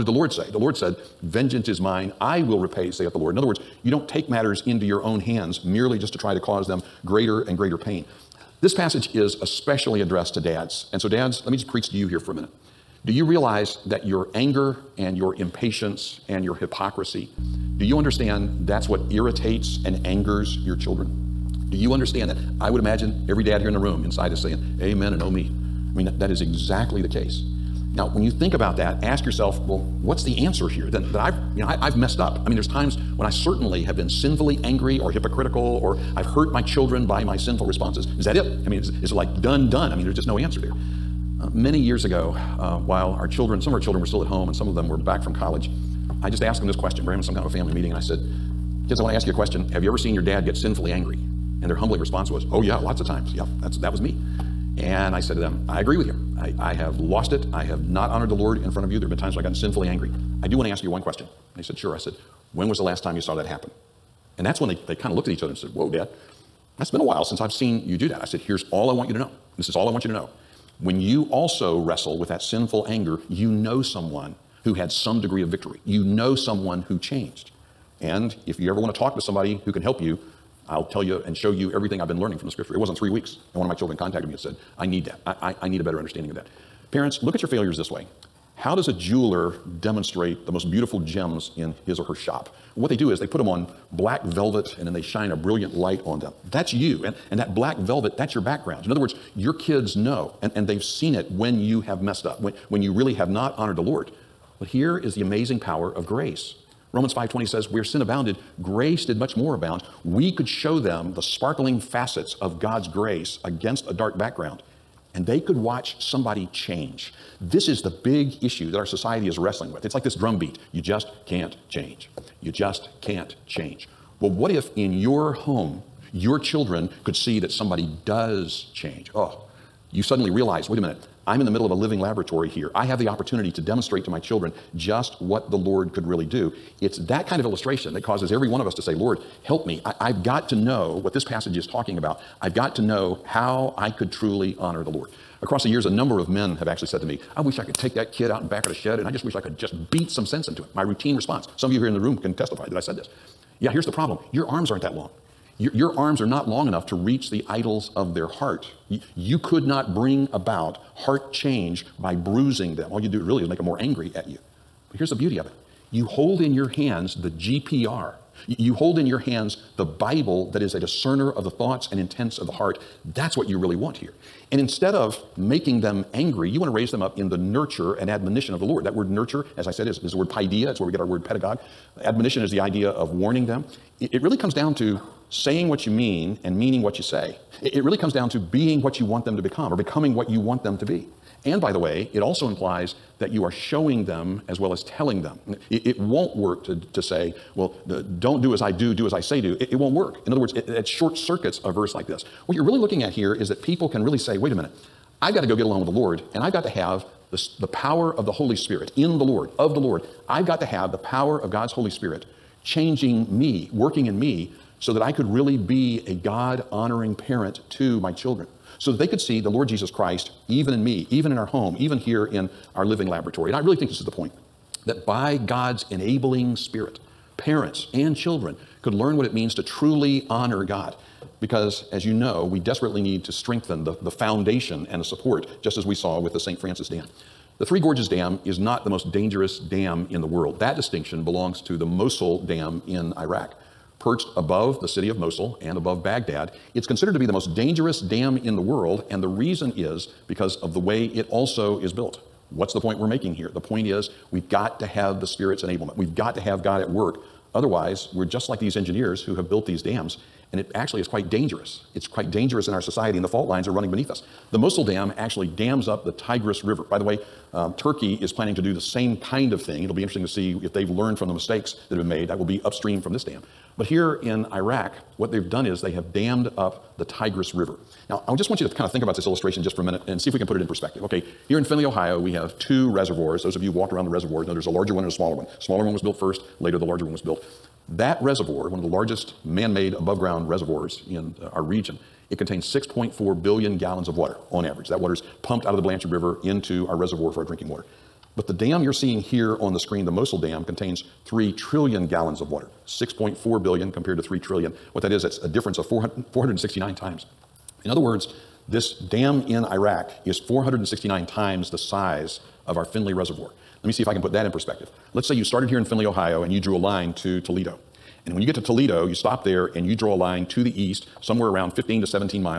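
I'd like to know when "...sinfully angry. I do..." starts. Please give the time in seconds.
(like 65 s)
59 s.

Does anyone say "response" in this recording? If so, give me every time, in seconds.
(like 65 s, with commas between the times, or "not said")
37 s, 51 s, 151 s.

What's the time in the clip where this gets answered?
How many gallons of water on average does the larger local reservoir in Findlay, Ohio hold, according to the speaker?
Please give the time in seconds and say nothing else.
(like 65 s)
292 s.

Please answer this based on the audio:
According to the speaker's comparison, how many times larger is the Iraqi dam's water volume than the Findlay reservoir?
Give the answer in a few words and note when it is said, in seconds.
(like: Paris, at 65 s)
469, at 310 s.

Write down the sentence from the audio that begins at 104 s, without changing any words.
But here is the amazing power of grace.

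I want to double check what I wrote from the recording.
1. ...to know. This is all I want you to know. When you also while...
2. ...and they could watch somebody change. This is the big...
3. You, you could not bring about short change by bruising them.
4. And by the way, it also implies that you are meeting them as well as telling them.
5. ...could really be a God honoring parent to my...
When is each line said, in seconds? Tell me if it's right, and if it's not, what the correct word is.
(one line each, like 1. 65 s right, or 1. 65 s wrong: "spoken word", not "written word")
1. 69 s wrong: "wrestle", not "while"
2. 115 s right
3. 158 s wrong: "heart", not "short"
4. 191 s wrong: "showing", not "meeting"
5. 215 s right.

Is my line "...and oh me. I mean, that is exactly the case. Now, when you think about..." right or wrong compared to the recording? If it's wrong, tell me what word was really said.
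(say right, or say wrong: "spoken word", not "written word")
right.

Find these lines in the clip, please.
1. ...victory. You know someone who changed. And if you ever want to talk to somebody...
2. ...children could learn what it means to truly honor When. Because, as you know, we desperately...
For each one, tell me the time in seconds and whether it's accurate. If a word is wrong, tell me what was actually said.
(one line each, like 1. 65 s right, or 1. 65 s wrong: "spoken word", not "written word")
1. 75 s right
2. 228 s wrong: "God", not "When".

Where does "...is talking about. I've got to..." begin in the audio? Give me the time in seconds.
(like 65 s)
141 s.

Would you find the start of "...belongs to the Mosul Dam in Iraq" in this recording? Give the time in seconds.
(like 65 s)
241 s.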